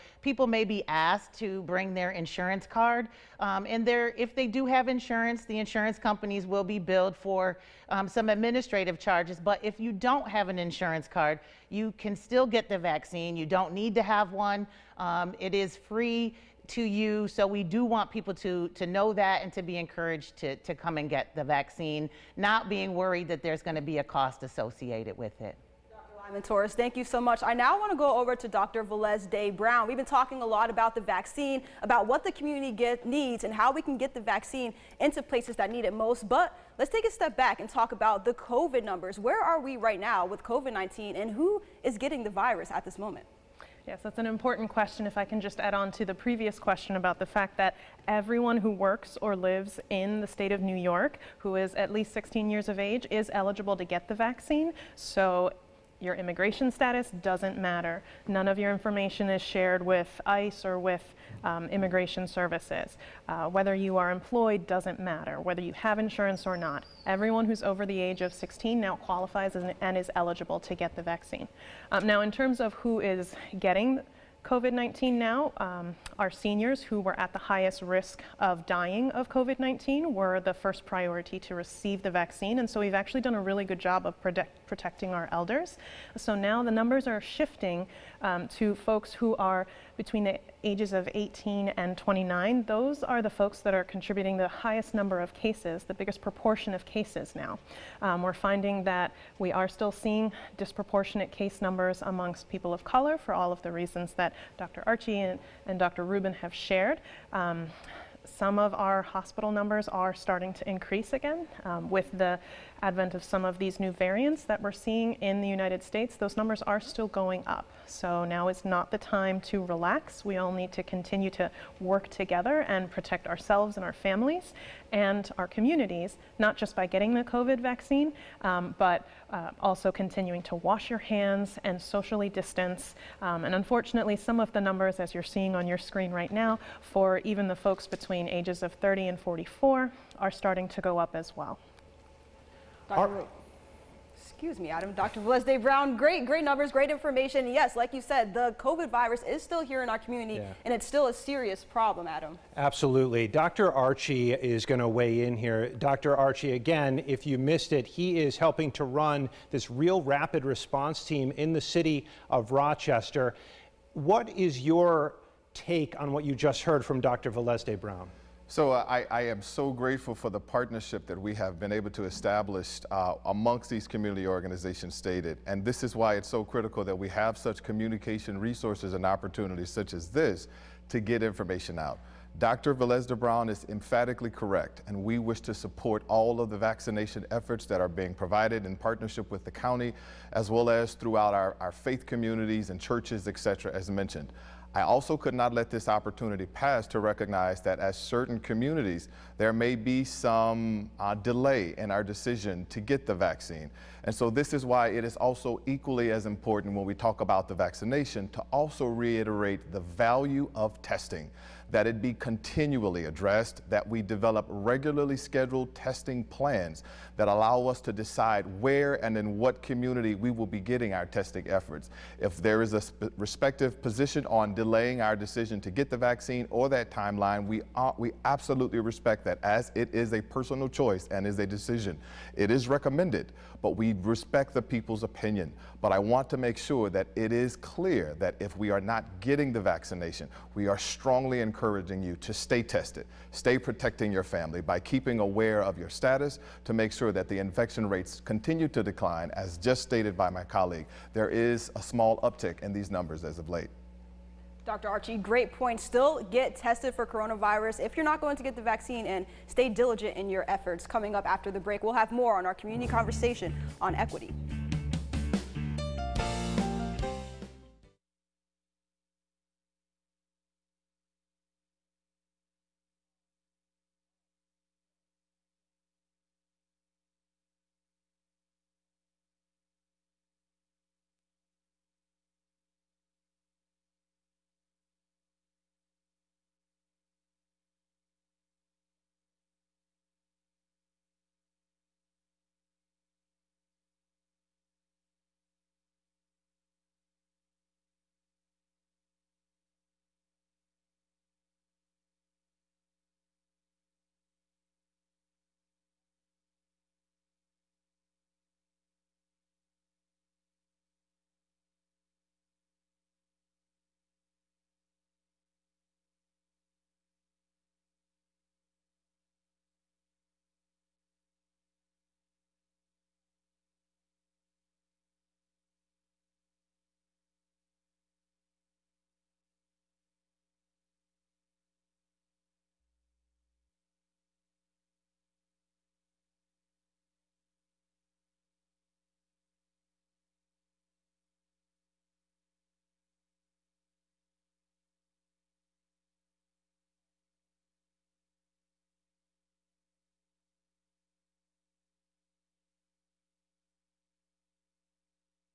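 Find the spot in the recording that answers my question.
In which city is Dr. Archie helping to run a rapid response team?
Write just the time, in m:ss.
2:42.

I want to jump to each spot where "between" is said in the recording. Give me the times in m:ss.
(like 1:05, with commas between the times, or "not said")
1:29, 2:17.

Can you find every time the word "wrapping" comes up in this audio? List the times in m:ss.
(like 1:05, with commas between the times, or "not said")
not said.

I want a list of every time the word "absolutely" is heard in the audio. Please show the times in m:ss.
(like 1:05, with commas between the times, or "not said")
2:32, 3:48.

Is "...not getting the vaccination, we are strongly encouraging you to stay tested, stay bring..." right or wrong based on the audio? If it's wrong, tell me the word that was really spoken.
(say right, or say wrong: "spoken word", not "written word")
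wrong: "protecting", not "bring".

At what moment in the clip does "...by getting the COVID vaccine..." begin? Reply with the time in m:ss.
2:06.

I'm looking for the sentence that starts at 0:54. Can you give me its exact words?
So your immigration status doesn't matter.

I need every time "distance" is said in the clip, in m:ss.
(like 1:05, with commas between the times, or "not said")
2:12.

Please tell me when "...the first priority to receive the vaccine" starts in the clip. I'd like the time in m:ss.
1:20.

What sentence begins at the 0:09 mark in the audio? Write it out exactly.
But if you don't have an insurance card, you can still get the vaccine.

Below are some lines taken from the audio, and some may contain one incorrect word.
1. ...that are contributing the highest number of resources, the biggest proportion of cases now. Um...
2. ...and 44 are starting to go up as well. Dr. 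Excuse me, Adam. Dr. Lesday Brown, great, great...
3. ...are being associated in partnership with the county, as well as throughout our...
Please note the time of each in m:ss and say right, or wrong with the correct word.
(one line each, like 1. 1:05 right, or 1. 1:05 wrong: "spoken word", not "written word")
1. 1:33 wrong: "cases", not "resources"
2. 2:19 right
3. 3:07 wrong: "provided", not "associated".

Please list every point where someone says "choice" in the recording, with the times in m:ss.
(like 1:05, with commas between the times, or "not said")
3:50.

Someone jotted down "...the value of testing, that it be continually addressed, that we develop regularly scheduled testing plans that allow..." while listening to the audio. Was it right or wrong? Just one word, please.
right.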